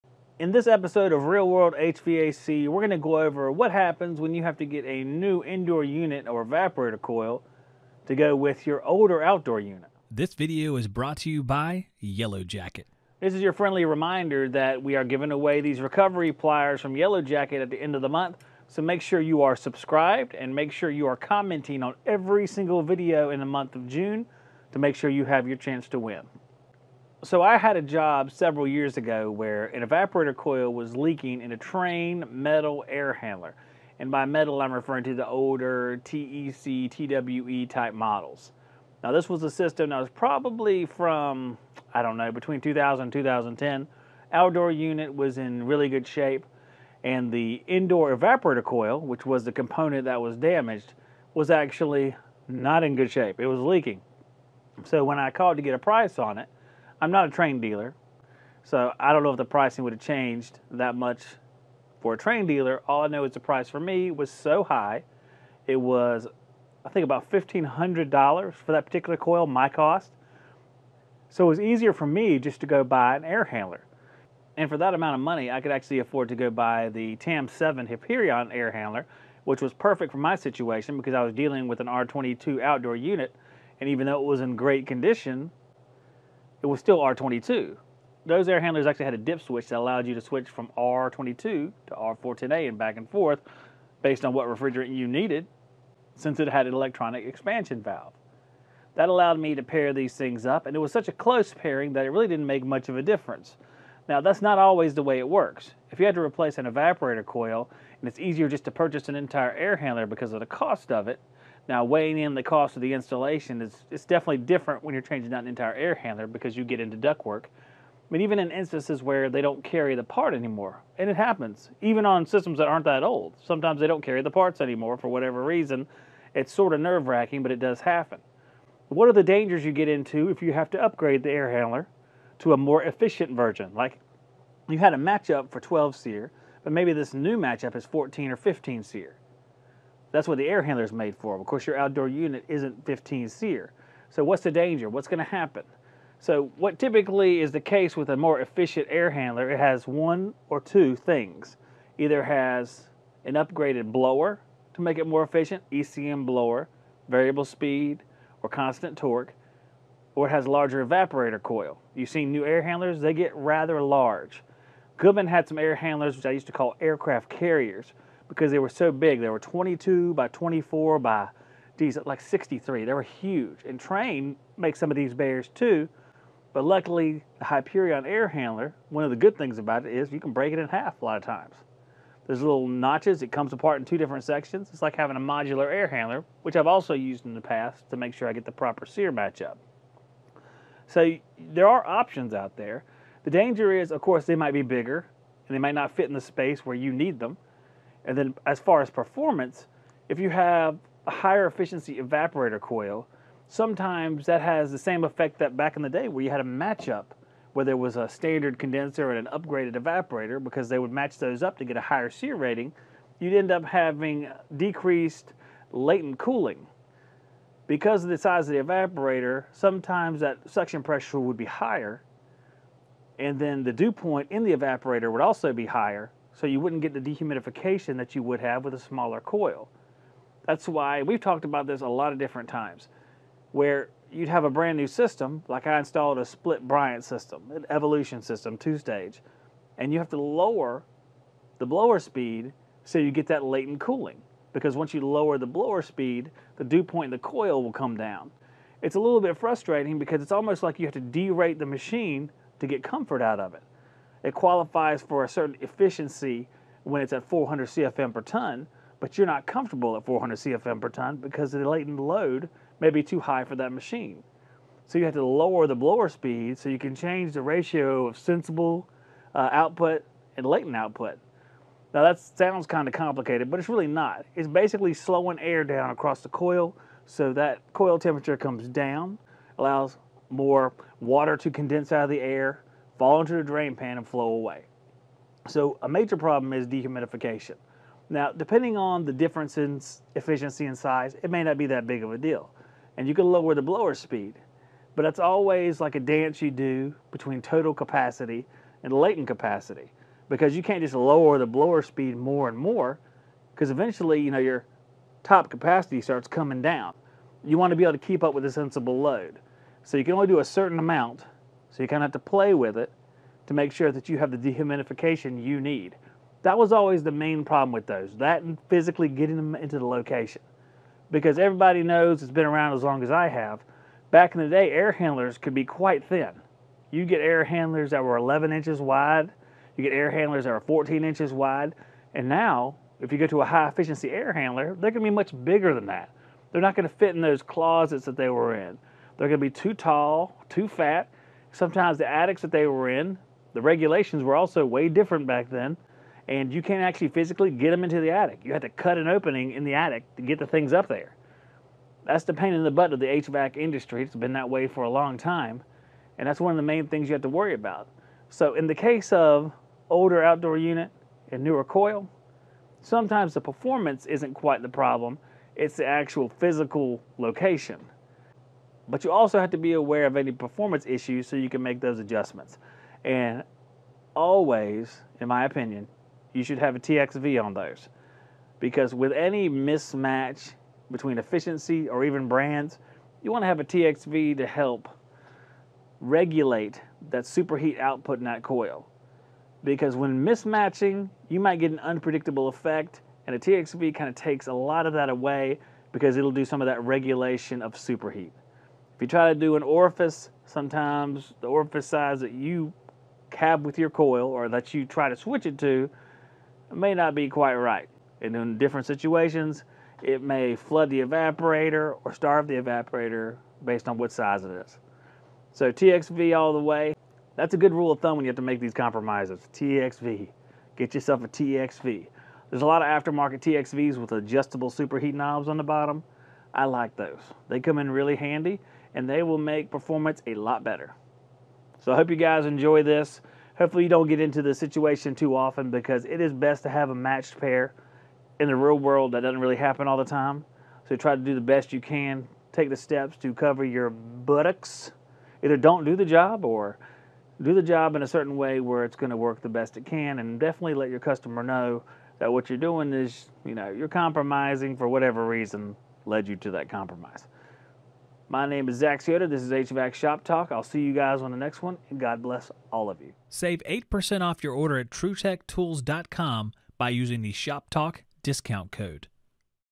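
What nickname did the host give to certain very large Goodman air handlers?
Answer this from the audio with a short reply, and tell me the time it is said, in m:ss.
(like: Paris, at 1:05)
aircraft carriers, at 2:46.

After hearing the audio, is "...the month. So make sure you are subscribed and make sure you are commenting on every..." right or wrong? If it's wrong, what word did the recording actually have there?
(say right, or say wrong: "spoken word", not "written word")
right.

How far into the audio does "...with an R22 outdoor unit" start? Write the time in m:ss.
1:21.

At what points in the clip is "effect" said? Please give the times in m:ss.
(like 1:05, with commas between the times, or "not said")
3:25, 6:32.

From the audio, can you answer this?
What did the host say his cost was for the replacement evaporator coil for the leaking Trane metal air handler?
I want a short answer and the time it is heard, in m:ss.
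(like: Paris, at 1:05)
$1,500, at 1:07.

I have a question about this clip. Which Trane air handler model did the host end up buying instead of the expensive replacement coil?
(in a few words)
TAM7 Hyperion.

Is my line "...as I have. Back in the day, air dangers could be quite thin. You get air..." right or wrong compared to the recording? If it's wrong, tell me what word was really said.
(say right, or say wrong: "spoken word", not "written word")
wrong: "handlers", not "dangers".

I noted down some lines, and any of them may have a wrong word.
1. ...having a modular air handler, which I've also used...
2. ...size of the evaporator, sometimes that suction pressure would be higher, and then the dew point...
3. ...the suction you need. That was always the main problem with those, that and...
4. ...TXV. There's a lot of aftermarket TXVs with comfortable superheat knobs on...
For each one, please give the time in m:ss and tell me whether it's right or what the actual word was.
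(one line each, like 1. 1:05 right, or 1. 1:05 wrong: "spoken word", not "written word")
1. 3:04 right
2. 3:38 right
3. 5:14 wrong: "dehumidification", not "suction"
4. 7:01 wrong: "adjustable", not "comfortable".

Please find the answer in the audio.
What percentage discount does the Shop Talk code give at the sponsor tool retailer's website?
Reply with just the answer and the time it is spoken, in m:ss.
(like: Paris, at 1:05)
8%, at 7:43.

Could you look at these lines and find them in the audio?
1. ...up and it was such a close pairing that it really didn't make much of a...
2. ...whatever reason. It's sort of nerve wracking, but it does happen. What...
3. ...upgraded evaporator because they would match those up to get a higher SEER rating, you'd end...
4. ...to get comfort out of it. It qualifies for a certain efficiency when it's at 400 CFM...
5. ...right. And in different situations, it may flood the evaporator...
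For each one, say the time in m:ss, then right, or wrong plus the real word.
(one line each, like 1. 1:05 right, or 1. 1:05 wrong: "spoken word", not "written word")
1. 1:40 right
2. 2:05 right
3. 3:29 right
4. 4:12 right
5. 6:47 right.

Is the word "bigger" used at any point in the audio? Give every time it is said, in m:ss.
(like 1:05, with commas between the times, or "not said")
3:14, 5:35.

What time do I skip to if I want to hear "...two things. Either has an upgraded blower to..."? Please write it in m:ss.
2:30.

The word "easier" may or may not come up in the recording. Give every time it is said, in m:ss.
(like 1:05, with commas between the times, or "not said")
1:11, 1:48.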